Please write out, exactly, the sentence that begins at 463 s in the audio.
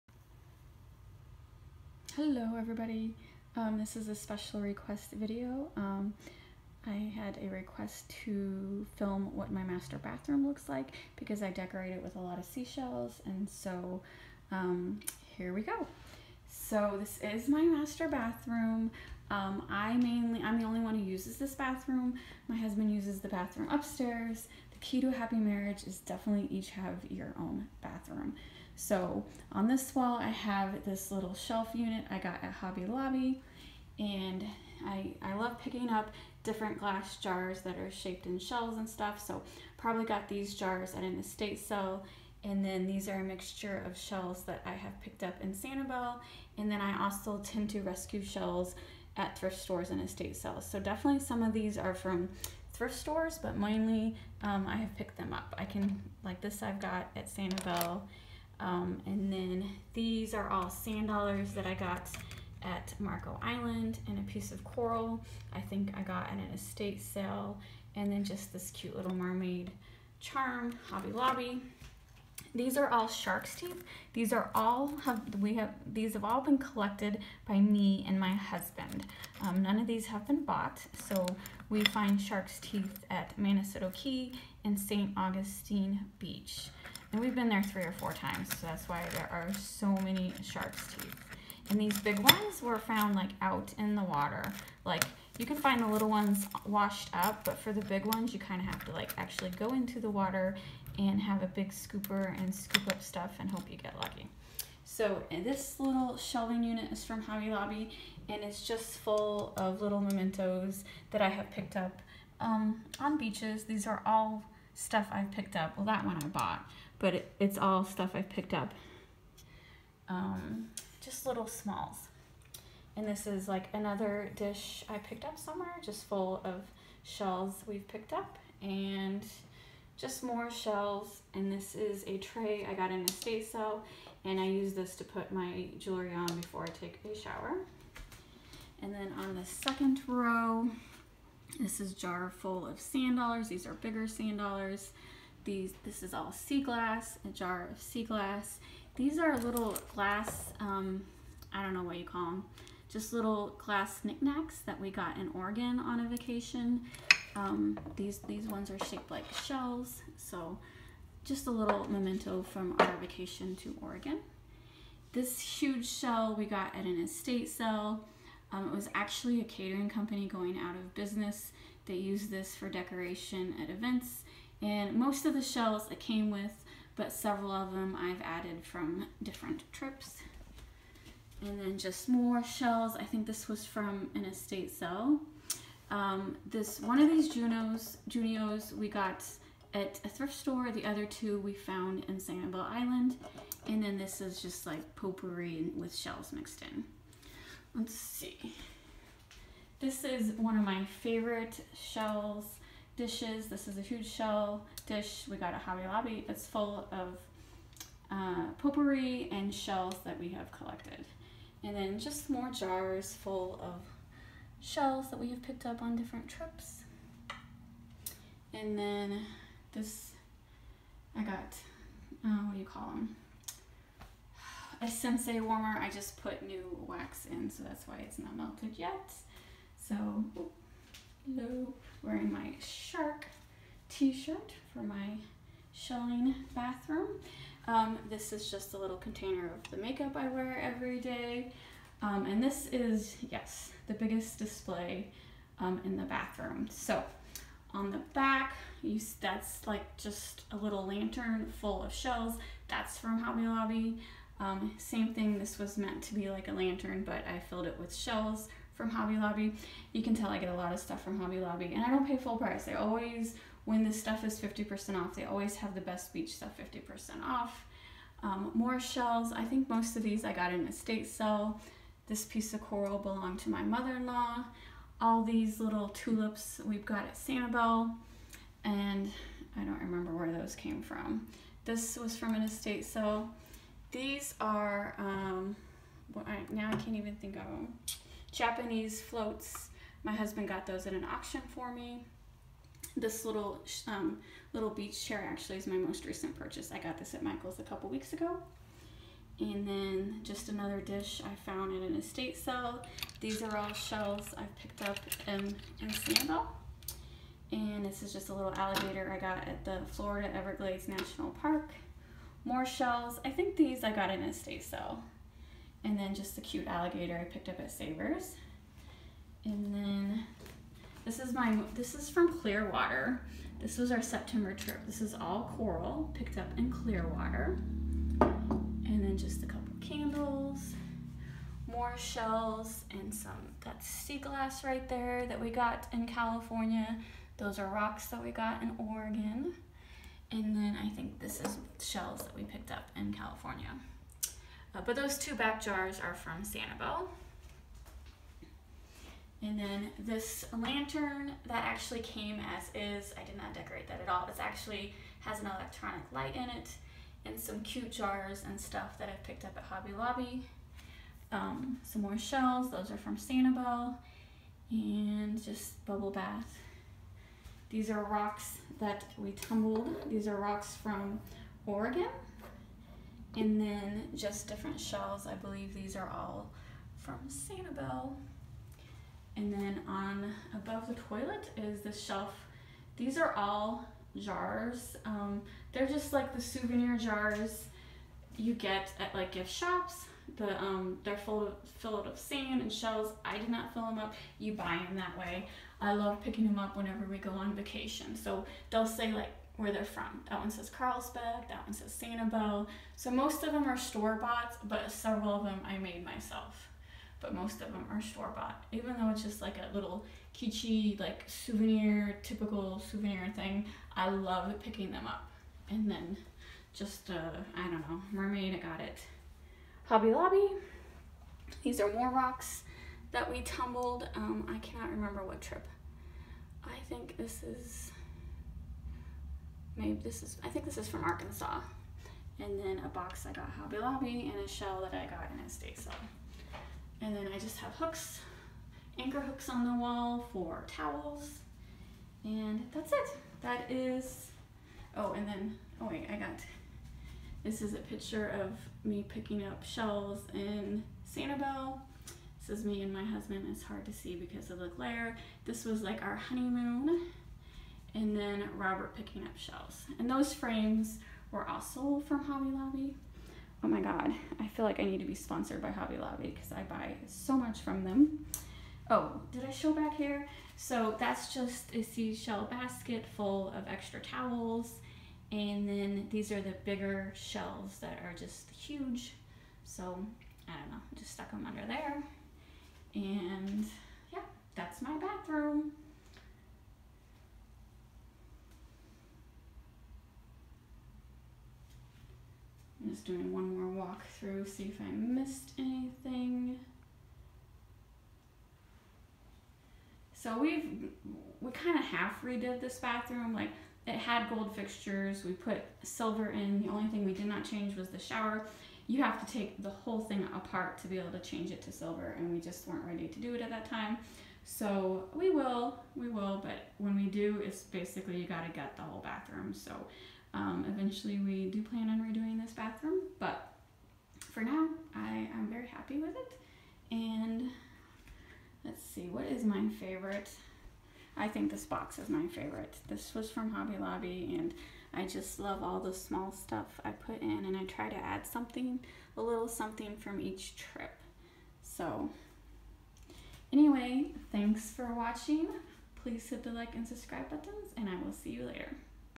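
Oh my God, I feel like I need to be sponsored by Hobby Lobby because I buy so much from them.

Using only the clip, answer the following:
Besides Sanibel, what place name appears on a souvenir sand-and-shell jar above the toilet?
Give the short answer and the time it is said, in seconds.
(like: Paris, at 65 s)
Carlsbad, at 400 s.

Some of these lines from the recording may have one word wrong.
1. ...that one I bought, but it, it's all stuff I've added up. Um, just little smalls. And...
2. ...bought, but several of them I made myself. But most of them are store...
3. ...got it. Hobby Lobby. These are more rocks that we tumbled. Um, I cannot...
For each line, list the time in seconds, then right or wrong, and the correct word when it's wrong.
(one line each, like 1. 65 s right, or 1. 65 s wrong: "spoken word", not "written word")
1. 115 s wrong: "picked", not "added"
2. 404 s right
3. 418 s right.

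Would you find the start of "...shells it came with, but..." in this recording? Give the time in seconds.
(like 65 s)
175 s.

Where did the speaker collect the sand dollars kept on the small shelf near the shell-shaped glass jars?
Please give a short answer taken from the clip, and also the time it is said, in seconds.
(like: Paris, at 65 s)
Marco Island, at 62 s.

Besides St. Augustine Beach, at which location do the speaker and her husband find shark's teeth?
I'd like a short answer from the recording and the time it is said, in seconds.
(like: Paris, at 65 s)
Manasota Key, at 83 s.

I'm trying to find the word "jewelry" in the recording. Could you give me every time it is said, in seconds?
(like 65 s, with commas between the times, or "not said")
135 s.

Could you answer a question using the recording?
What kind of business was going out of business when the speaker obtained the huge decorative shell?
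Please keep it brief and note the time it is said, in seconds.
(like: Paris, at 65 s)
Catering company, at 169 s.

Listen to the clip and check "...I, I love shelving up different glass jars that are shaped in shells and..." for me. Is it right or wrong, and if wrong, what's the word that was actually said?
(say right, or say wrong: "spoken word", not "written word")
wrong: "picking", not "shelving".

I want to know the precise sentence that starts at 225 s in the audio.
I just put new wax in, so that's why it's not melted yet.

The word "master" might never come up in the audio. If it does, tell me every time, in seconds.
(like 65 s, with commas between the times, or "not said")
9 s, 17 s.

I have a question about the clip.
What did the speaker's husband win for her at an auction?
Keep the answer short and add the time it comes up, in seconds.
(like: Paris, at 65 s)
Japanese floats, at 288 s.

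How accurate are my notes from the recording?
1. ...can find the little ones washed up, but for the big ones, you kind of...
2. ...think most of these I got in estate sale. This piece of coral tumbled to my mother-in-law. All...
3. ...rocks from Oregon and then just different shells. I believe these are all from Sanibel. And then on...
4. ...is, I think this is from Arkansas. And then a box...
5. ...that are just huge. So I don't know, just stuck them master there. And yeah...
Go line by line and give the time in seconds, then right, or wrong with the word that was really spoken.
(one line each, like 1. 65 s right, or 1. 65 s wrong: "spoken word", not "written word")
1. 95 s right
2. 269 s wrong: "belonged", not "tumbled"
3. 370 s right
4. 430 s right
5. 477 s wrong: "under", not "master".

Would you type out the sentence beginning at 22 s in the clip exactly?
My husband uses the bathroom upstairs.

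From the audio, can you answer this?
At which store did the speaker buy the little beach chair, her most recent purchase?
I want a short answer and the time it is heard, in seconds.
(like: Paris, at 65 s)
Michael's, at 297 s.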